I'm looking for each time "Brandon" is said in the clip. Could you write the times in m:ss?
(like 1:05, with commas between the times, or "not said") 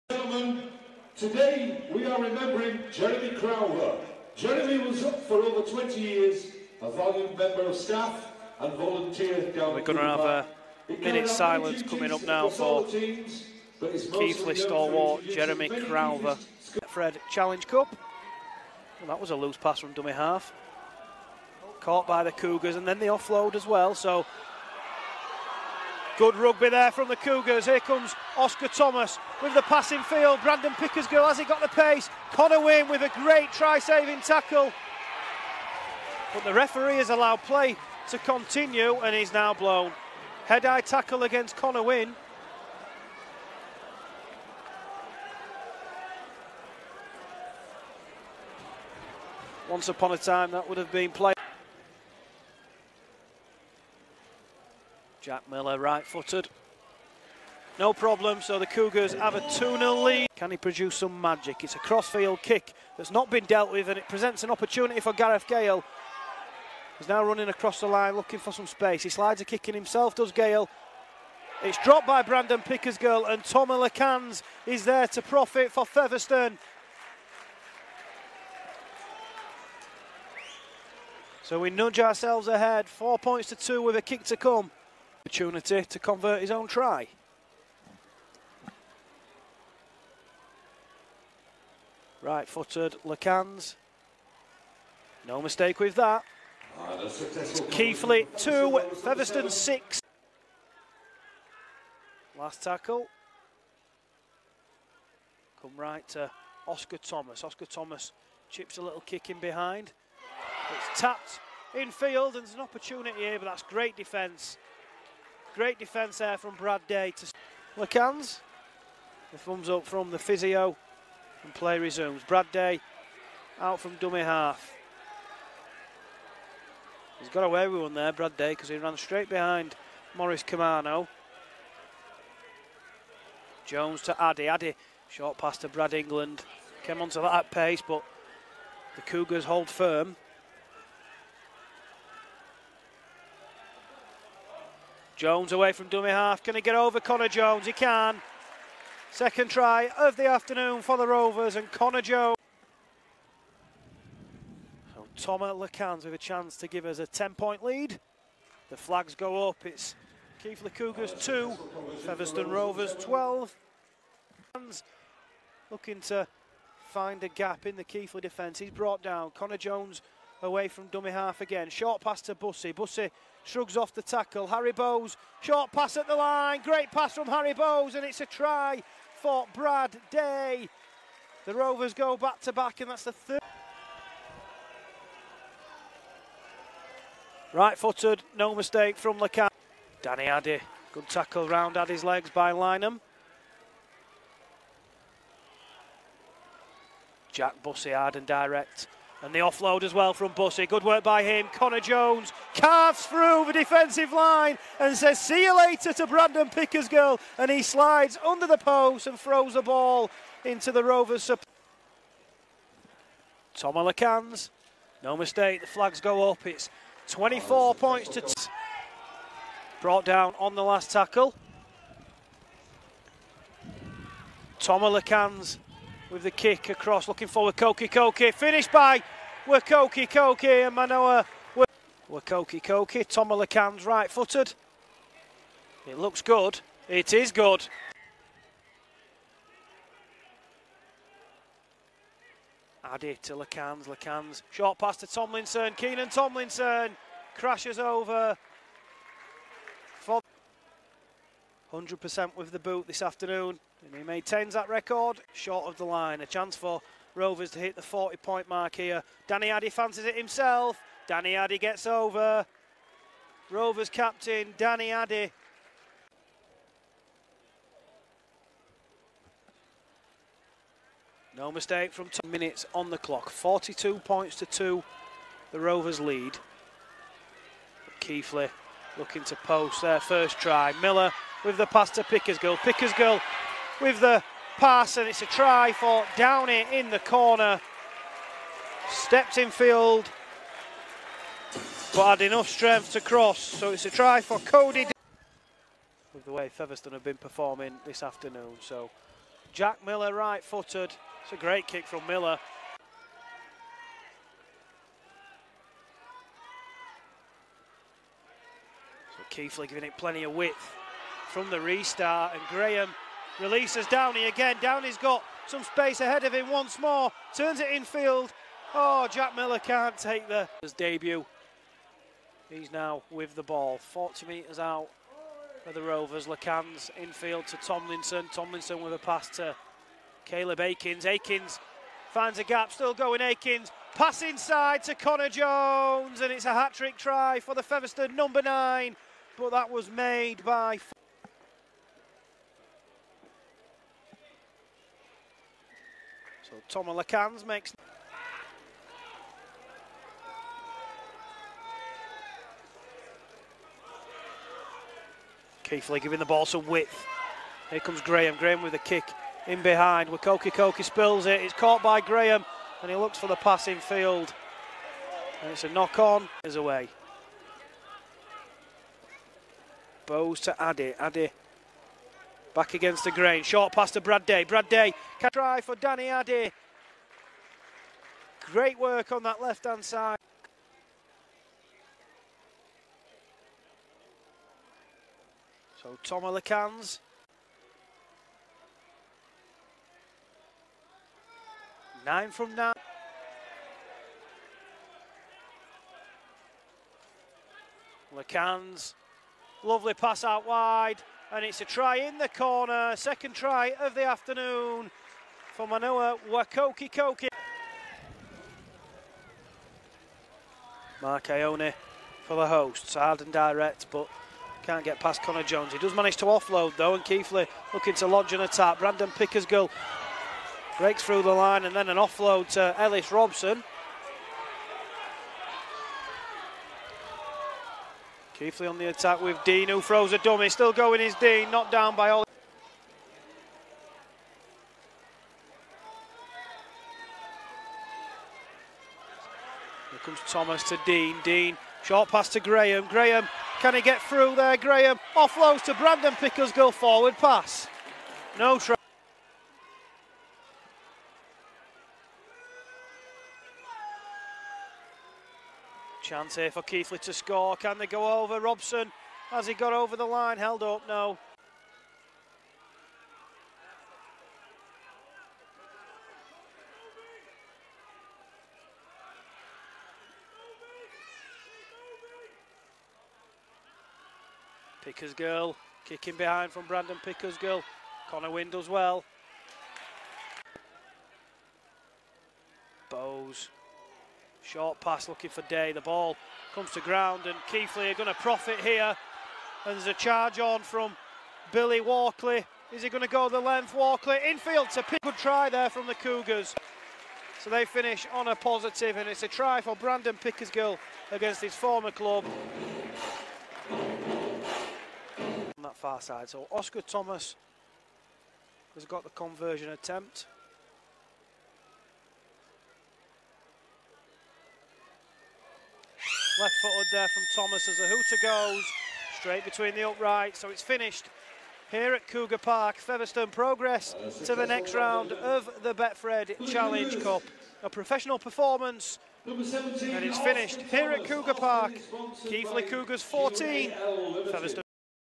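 0:30, 1:12, 3:26, 6:58, 7:25, 7:56, 8:19.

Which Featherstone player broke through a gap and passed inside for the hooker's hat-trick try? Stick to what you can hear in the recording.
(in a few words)
Caleb Aekins.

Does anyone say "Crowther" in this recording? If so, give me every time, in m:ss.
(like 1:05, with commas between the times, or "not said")
0:03, 0:15.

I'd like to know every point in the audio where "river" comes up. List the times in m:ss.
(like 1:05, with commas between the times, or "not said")
not said.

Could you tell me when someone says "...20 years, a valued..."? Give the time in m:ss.
0:05.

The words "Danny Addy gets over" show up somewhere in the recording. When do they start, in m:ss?
4:21.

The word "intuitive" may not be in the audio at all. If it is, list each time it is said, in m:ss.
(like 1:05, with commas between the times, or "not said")
not said.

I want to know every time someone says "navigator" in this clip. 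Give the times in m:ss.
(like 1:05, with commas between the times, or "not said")
not said.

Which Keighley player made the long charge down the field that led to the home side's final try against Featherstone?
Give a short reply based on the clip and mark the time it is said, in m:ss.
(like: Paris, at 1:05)
Billy Walkley, at 8:11.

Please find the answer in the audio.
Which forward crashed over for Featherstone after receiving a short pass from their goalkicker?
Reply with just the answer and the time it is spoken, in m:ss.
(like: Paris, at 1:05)
Keenan Tomlinson, at 4:05.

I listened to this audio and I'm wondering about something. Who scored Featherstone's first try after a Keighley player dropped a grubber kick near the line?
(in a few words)
Tommy Lacans.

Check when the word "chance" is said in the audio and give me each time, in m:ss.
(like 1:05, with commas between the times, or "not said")
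2:36, 4:16, 7:36.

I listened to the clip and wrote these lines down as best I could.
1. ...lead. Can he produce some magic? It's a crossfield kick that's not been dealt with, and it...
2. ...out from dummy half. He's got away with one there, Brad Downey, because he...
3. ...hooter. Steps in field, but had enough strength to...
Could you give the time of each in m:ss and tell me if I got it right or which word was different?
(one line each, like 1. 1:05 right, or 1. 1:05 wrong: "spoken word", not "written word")
1. 1:00 right
2. 2:03 wrong: "Day", not "Downey"
3. 4:46 wrong: "corner", not "hooter".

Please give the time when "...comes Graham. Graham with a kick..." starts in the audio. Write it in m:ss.
5:57.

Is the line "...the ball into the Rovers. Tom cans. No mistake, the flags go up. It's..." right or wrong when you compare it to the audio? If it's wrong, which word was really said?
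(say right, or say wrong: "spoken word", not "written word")
right.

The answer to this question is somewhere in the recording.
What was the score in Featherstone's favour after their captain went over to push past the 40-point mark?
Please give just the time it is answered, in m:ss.
4:33.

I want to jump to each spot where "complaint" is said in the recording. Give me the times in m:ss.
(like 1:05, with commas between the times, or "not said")
not said.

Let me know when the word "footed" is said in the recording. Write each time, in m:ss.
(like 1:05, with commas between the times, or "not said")
0:56, 1:32, 3:07, 3:54, 5:00, 8:36.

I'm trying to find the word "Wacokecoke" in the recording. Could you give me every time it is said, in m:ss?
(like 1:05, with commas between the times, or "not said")
3:49, 6:00, 6:46.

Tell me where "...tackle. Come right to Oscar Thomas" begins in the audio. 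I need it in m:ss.
1:42.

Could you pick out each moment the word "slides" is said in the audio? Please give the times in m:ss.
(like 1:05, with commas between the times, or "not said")
1:09, 3:27.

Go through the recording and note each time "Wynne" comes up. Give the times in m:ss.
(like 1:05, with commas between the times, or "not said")
0:32, 0:41, 7:58.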